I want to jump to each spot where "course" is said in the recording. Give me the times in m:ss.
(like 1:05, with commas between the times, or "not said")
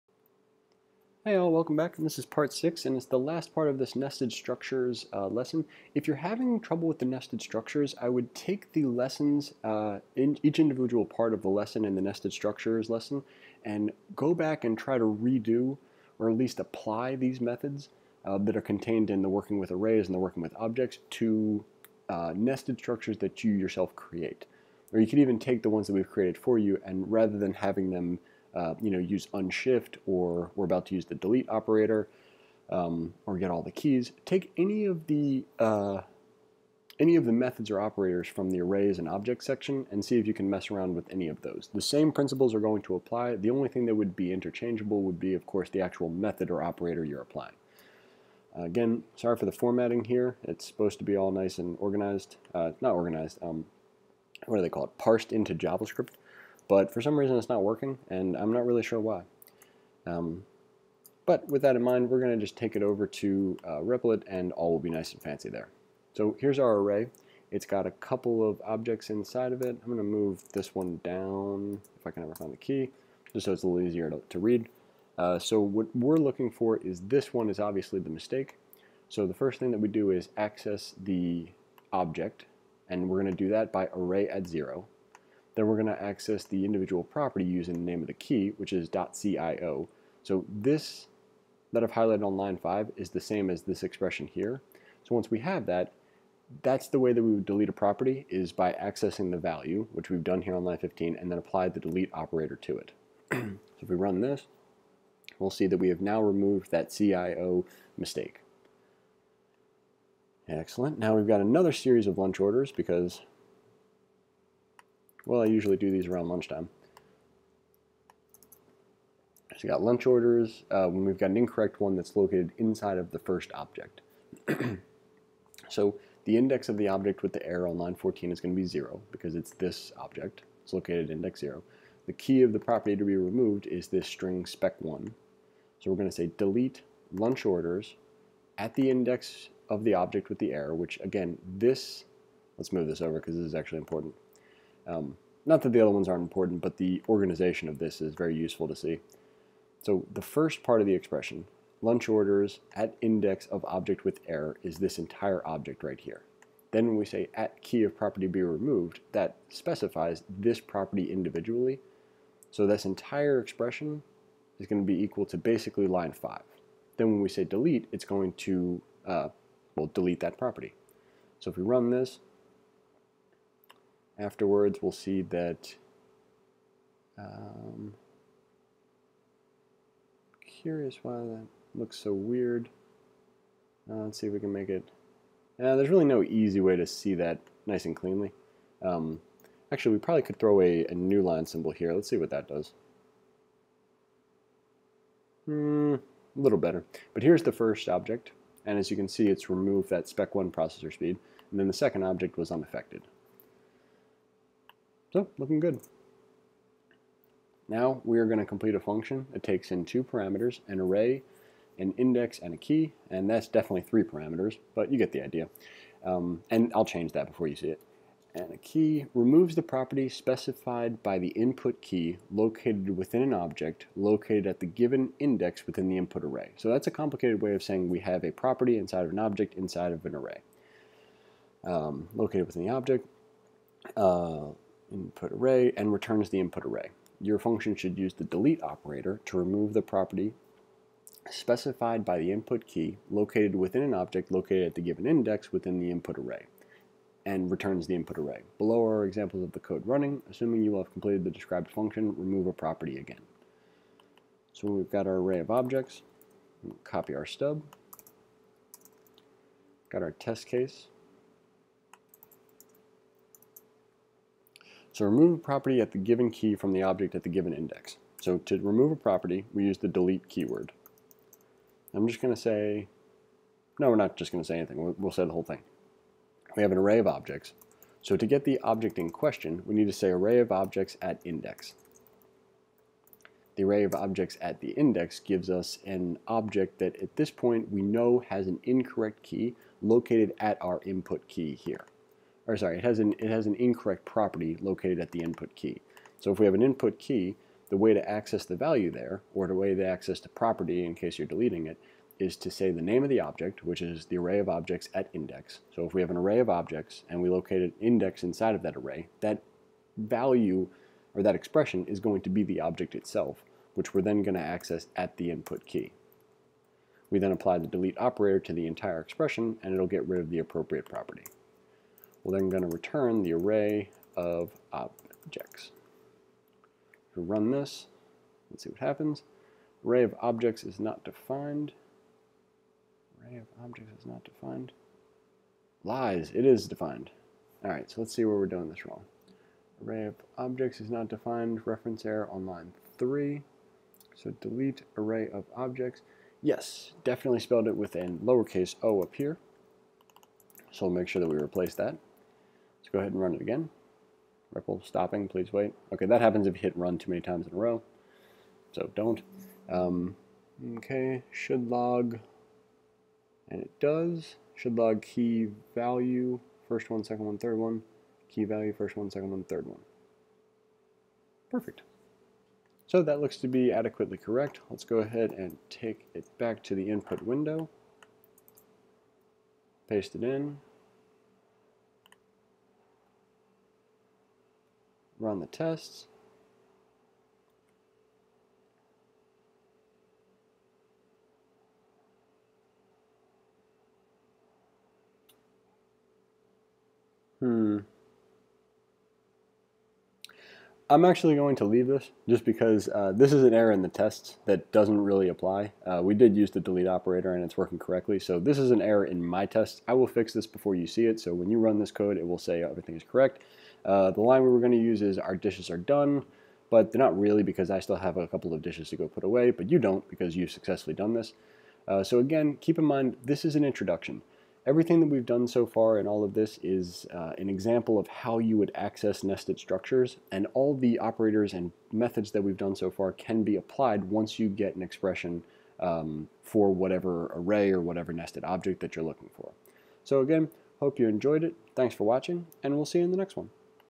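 0:45.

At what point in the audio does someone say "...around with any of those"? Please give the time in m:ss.
0:40.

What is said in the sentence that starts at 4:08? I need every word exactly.
Below are examples of the code running.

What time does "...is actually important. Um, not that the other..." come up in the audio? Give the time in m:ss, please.
2:23.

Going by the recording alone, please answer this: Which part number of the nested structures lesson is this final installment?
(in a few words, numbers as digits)
6.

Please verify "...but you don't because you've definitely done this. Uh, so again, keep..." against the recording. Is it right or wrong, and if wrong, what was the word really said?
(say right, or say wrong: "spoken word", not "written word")
wrong: "successfully", not "definitely".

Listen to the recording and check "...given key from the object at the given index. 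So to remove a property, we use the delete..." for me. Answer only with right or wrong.
right.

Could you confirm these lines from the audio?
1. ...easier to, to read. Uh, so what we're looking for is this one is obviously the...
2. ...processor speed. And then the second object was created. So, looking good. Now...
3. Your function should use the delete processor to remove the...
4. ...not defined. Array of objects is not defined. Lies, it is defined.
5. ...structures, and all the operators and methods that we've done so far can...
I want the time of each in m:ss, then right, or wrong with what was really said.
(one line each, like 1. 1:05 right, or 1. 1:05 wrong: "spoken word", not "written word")
1. 1:13 right
2. 3:20 wrong: "unaffected", not "created"
3. 3:57 wrong: "operator", not "processor"
4. 5:30 right
5. 7:09 right.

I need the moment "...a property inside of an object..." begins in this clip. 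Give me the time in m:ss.
3:48.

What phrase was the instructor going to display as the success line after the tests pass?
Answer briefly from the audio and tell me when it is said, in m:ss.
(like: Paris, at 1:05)
our dishes are done, at 6:55.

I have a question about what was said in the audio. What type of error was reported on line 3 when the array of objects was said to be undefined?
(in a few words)
reference error.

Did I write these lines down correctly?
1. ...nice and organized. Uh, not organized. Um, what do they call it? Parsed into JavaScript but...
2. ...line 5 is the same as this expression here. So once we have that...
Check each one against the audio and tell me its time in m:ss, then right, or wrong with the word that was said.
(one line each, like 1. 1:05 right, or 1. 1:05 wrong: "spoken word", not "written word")
1. 0:51 right
2. 1:32 right.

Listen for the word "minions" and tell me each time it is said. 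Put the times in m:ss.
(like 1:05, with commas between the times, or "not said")
not said.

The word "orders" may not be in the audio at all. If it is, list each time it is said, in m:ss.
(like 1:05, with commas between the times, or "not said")
1:52, 2:00, 2:17, 2:32.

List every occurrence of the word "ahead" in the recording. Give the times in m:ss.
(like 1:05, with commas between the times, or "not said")
5:52, 6:14.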